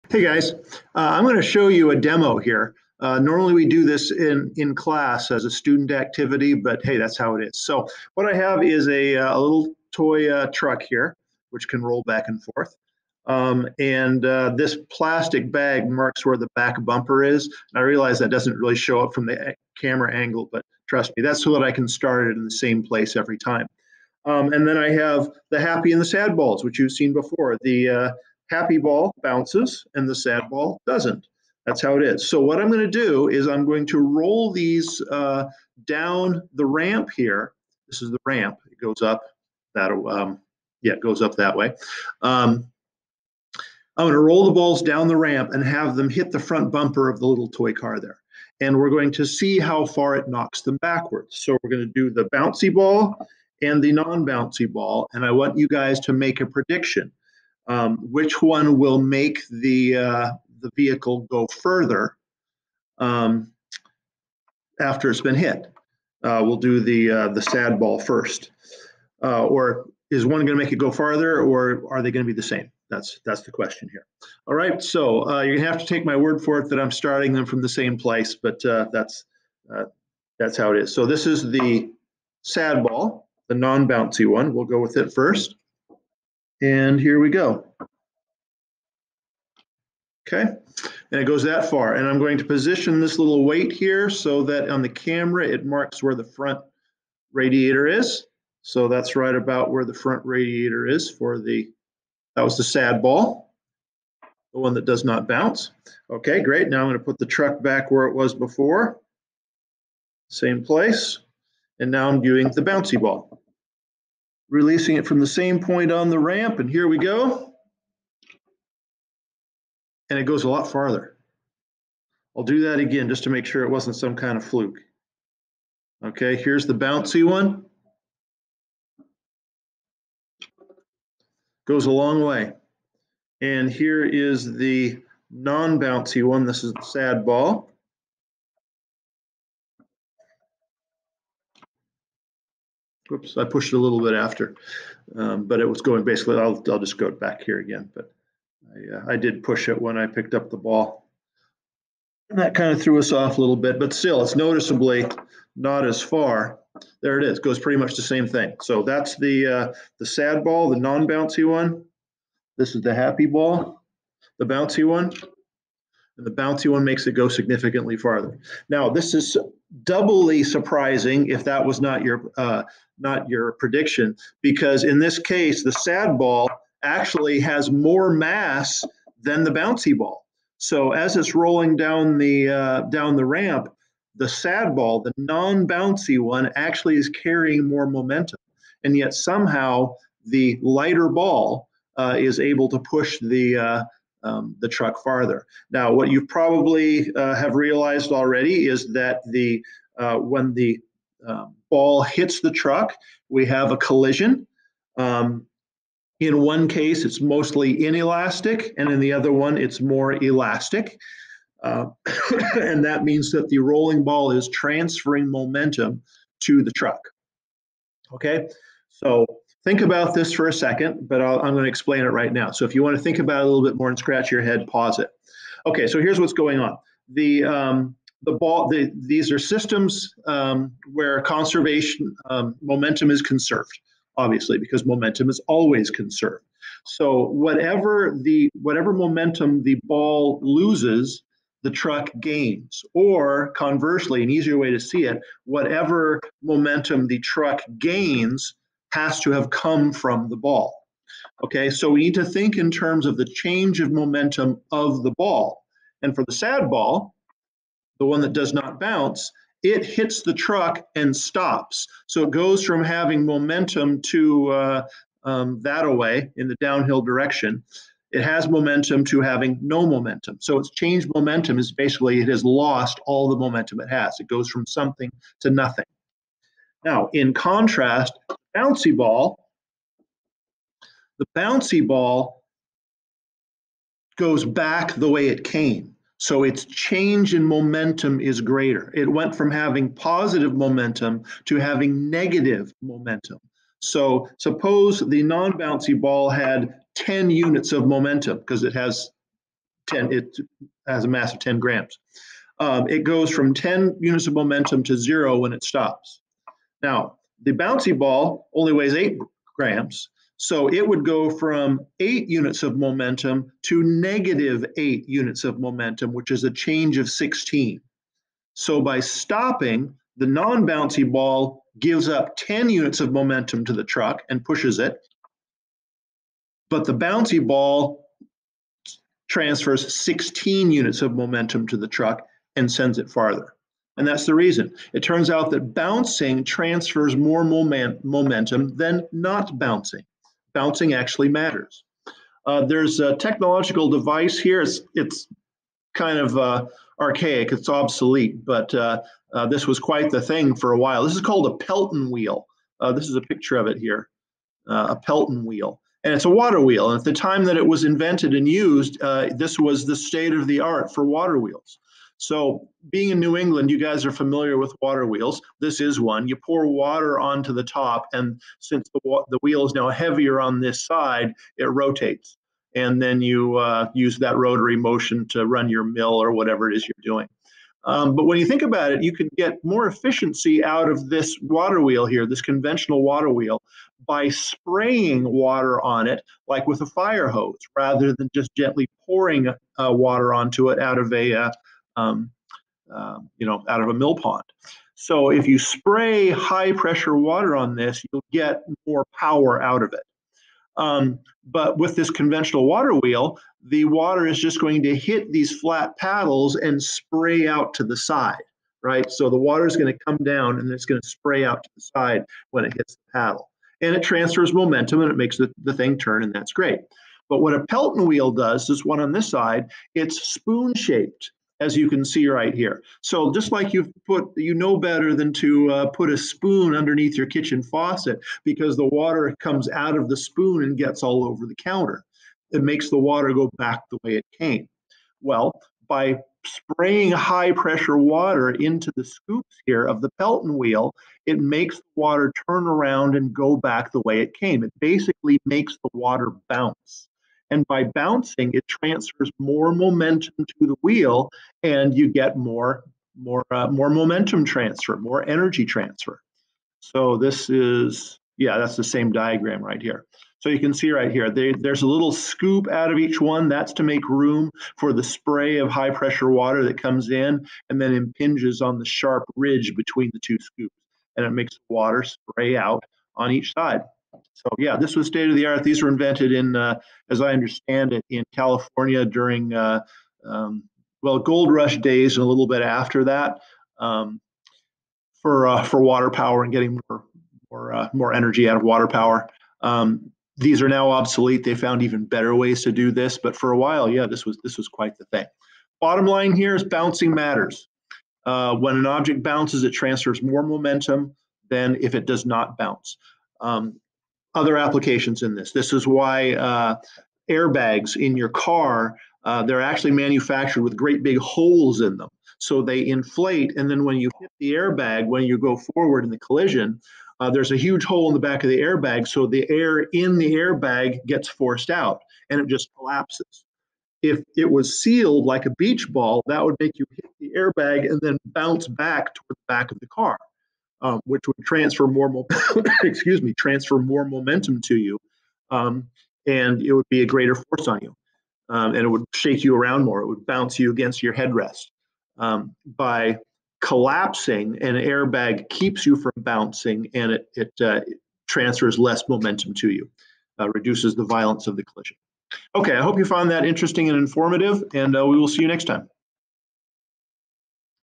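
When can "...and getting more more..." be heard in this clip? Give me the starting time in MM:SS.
08:06.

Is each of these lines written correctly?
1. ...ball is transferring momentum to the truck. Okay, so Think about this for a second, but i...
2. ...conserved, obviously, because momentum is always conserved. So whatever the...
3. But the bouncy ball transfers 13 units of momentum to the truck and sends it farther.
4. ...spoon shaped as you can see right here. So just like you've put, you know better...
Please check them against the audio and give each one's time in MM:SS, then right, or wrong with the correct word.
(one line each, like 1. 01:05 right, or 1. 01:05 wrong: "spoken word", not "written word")
1. 03:34 right
2. 03:53 right
3. 05:26 wrong: "16", not "13"
4. 07:00 right.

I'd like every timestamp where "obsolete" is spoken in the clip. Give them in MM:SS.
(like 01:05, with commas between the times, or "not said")
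05:47, 08:10.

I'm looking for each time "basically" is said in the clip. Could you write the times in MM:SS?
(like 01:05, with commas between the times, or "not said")
02:26, 04:31, 07:24.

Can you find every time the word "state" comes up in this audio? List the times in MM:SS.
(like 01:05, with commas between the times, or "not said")
05:59, 07:55.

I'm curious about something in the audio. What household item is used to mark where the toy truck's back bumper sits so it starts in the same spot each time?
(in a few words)
plastic bag.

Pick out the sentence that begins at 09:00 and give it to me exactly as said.
It would bounce you against your headrest.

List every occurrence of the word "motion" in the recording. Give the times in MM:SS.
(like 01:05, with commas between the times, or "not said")
06:14.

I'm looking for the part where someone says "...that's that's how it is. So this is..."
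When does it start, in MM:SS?
01:18.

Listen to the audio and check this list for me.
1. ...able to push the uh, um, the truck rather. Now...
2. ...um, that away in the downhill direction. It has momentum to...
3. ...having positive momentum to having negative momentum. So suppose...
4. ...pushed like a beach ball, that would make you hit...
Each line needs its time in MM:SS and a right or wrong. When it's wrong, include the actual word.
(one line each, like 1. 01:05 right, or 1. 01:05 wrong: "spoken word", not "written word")
1. 03:12 wrong: "farther", not "rather"
2. 04:25 right
3. 04:49 right
4. 08:44 wrong: "sealed", not "pushed".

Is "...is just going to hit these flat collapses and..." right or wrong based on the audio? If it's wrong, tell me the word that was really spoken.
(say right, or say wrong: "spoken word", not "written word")
wrong: "paddles", not "collapses".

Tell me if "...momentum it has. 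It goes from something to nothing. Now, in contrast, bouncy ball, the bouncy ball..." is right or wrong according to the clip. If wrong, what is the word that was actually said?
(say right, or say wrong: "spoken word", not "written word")
right.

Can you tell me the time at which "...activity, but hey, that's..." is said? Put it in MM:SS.
00:05.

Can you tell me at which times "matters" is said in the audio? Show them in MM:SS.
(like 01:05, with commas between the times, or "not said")
05:41, 08:17.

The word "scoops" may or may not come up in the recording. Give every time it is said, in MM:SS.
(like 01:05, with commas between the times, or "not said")
07:19, 07:42, 07:50.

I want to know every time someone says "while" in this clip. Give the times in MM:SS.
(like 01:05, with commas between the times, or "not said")
05:50, 08:13.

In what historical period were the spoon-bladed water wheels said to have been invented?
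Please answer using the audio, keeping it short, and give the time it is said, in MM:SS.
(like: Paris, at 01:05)
gold rush days, at 08:01.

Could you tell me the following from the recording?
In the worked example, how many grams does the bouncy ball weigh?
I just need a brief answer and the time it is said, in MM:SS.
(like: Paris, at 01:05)
8 grams, at 05:08.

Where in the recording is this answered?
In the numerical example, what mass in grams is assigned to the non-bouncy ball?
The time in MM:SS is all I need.
05:01.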